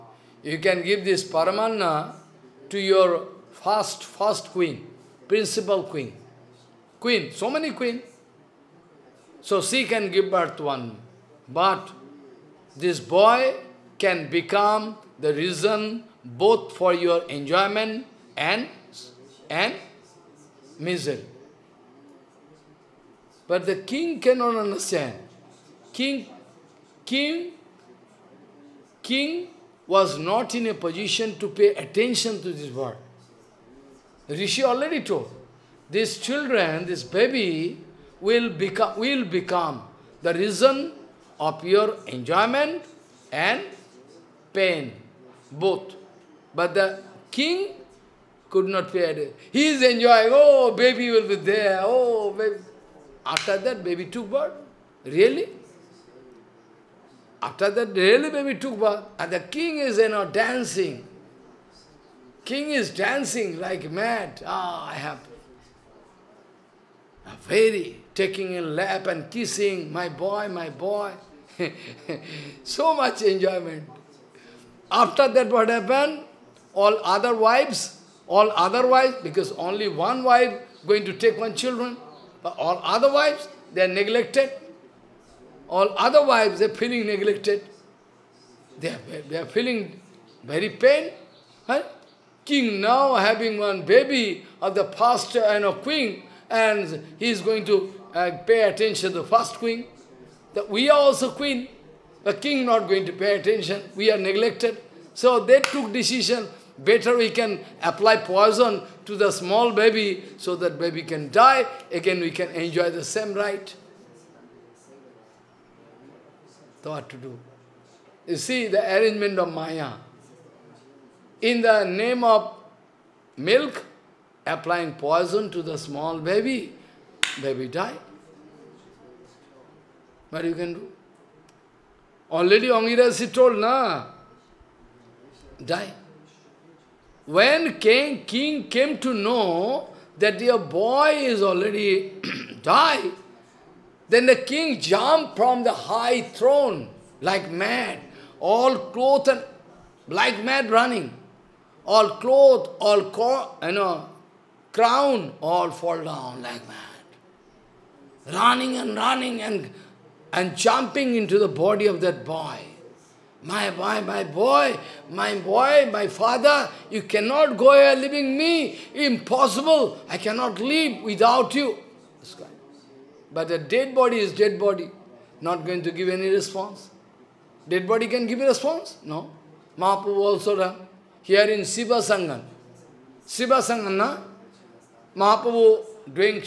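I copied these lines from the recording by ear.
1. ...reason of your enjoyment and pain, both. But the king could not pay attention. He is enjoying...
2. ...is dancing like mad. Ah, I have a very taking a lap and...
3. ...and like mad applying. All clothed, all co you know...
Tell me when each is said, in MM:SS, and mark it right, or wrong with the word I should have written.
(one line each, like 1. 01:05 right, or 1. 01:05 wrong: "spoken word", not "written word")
1. 00:40 right
2. 01:02 right
3. 02:29 wrong: "running", not "applying".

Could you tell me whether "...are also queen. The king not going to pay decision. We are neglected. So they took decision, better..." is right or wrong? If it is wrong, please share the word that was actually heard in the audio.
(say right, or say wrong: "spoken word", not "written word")
wrong: "attention", not "decision".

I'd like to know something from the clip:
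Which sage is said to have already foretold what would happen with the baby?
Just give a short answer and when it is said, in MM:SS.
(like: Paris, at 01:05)
Angirasi, at 02:12.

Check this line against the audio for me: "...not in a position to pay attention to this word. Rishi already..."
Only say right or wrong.
right.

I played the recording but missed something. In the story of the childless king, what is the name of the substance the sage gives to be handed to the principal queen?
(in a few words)
Paramanna.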